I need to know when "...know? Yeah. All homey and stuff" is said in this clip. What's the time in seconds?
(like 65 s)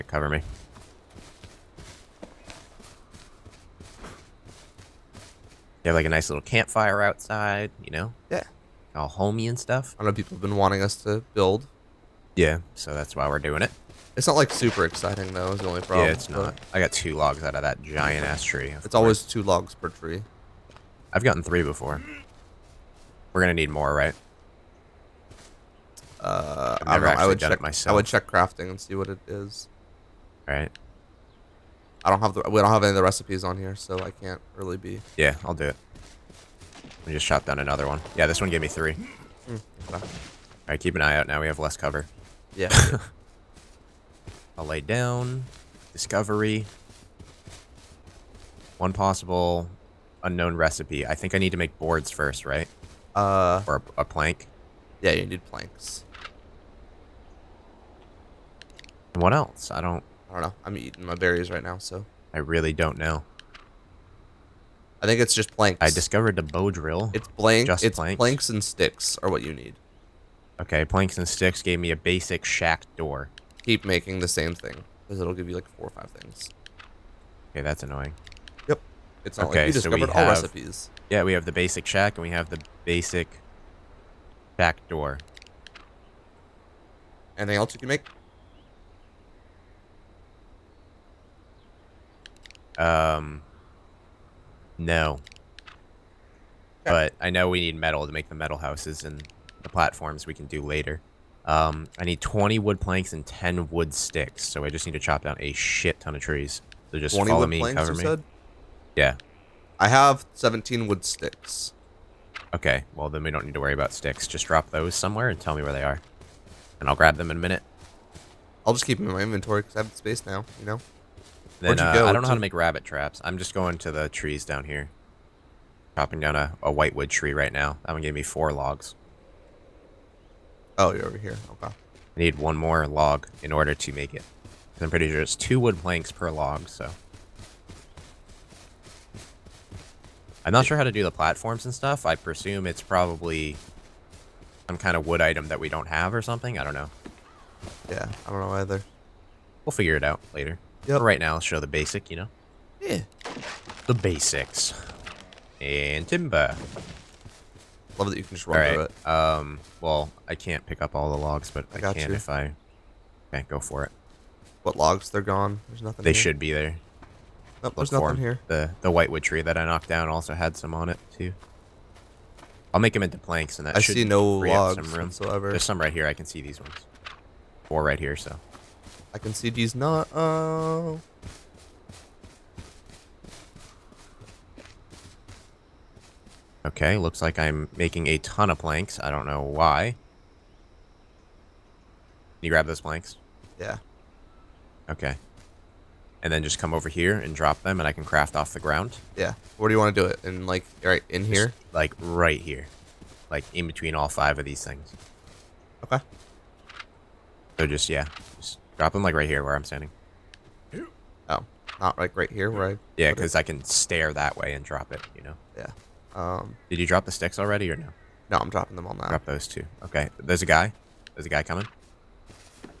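7 s.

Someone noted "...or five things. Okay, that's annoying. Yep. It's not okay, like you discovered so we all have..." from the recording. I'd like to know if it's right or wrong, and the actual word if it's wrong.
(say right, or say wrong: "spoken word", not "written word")
right.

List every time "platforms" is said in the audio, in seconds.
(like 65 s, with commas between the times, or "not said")
99 s, 141 s.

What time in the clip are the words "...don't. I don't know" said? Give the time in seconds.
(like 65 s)
59 s.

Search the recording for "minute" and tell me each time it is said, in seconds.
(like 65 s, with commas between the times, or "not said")
117 s.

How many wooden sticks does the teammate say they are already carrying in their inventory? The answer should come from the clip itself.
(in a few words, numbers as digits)
17.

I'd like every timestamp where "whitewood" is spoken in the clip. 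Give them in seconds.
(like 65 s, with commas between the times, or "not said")
126 s, 168 s.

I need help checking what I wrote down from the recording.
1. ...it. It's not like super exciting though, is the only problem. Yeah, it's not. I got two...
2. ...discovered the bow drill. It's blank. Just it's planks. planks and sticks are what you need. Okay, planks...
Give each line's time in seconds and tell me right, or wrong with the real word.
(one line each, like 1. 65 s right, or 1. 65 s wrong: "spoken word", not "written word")
1. 13 s right
2. 65 s right.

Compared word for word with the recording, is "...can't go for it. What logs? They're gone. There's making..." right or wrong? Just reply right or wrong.
wrong.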